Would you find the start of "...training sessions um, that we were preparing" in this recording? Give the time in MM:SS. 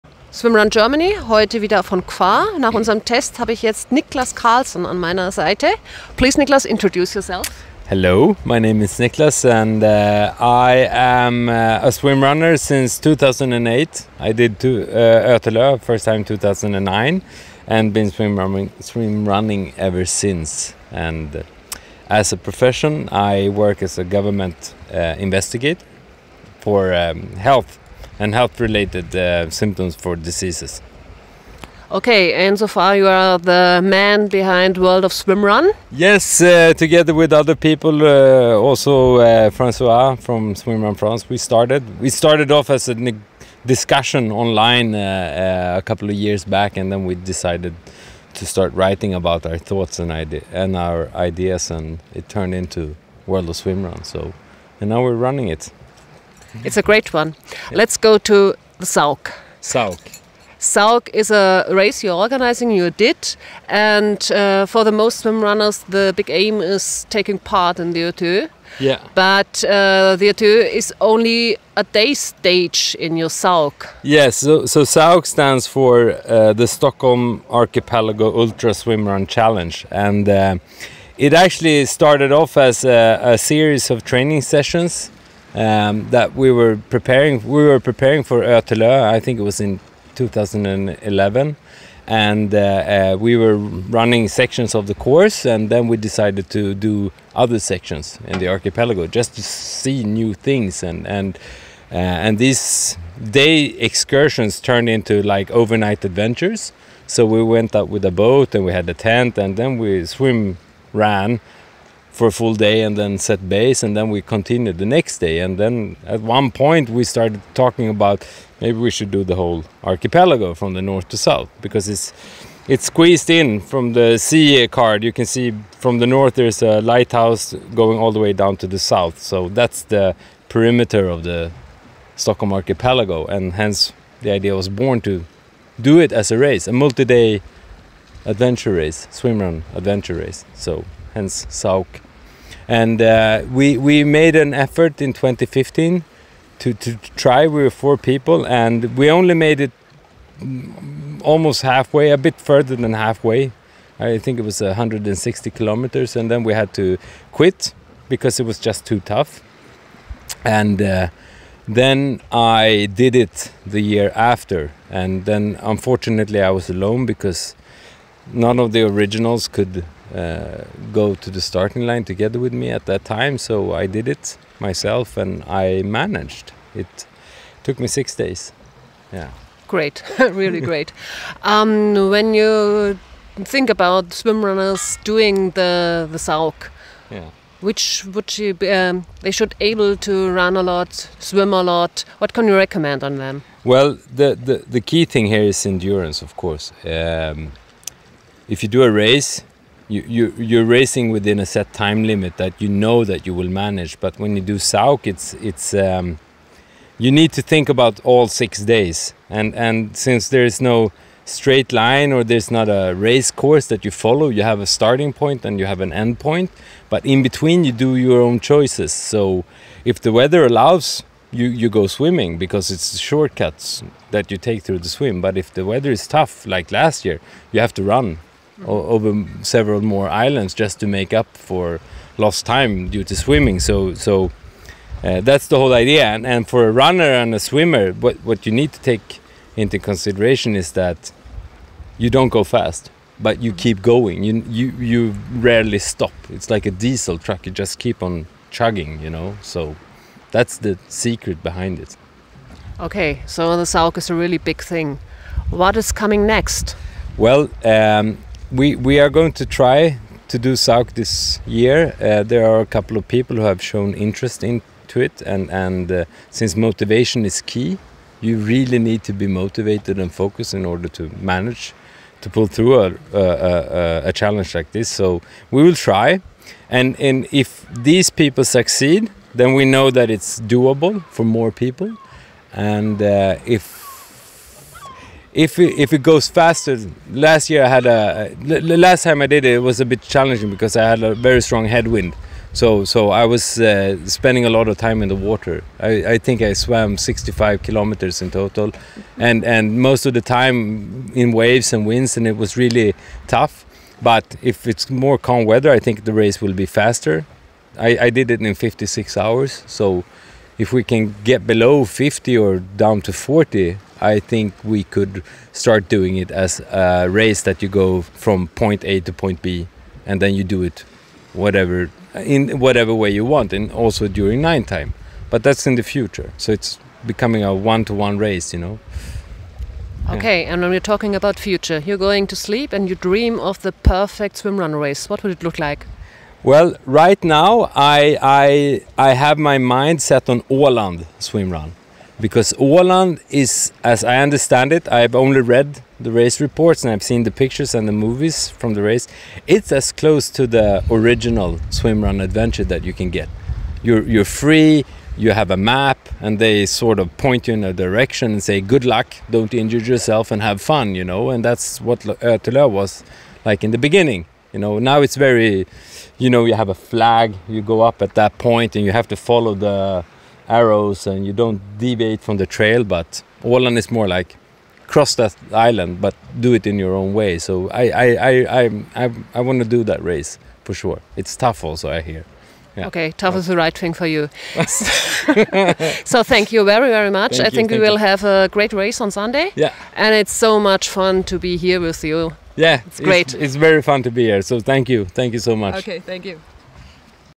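01:24.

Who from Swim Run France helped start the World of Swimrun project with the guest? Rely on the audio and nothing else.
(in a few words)
Francois.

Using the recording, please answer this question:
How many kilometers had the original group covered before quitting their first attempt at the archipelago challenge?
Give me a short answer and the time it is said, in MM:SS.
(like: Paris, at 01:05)
160 kilometers, at 02:34.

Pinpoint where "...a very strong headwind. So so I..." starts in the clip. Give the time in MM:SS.
04:51.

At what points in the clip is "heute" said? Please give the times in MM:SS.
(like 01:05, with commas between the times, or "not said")
00:01.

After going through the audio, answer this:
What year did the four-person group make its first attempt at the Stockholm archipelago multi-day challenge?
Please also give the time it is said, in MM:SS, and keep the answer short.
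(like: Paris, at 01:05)
2015, at 02:25.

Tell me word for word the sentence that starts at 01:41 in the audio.
Uh, and these day excursions turned into like overnight adventures.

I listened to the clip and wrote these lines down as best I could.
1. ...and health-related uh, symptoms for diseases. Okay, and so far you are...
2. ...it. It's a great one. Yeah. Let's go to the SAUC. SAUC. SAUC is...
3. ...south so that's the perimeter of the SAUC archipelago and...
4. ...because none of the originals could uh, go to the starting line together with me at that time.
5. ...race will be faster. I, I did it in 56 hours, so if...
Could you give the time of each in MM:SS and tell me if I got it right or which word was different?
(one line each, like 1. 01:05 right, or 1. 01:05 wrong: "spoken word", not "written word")
1. 00:28 right
2. 00:55 right
3. 02:08 wrong: "Stockholm", not "SAUC"
4. 02:47 right
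5. 05:06 right.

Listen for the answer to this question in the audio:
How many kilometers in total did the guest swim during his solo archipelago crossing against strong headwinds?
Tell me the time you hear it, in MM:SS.
04:56.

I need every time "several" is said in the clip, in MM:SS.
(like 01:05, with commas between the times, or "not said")
03:49.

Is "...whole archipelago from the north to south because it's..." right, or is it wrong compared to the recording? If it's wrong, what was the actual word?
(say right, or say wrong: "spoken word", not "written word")
right.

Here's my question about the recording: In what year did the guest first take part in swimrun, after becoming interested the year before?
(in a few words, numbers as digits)
2009.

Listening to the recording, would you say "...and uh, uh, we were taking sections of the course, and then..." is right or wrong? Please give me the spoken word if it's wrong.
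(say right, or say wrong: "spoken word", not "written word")
wrong: "running", not "taking".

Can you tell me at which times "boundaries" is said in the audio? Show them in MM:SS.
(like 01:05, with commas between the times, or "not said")
not said.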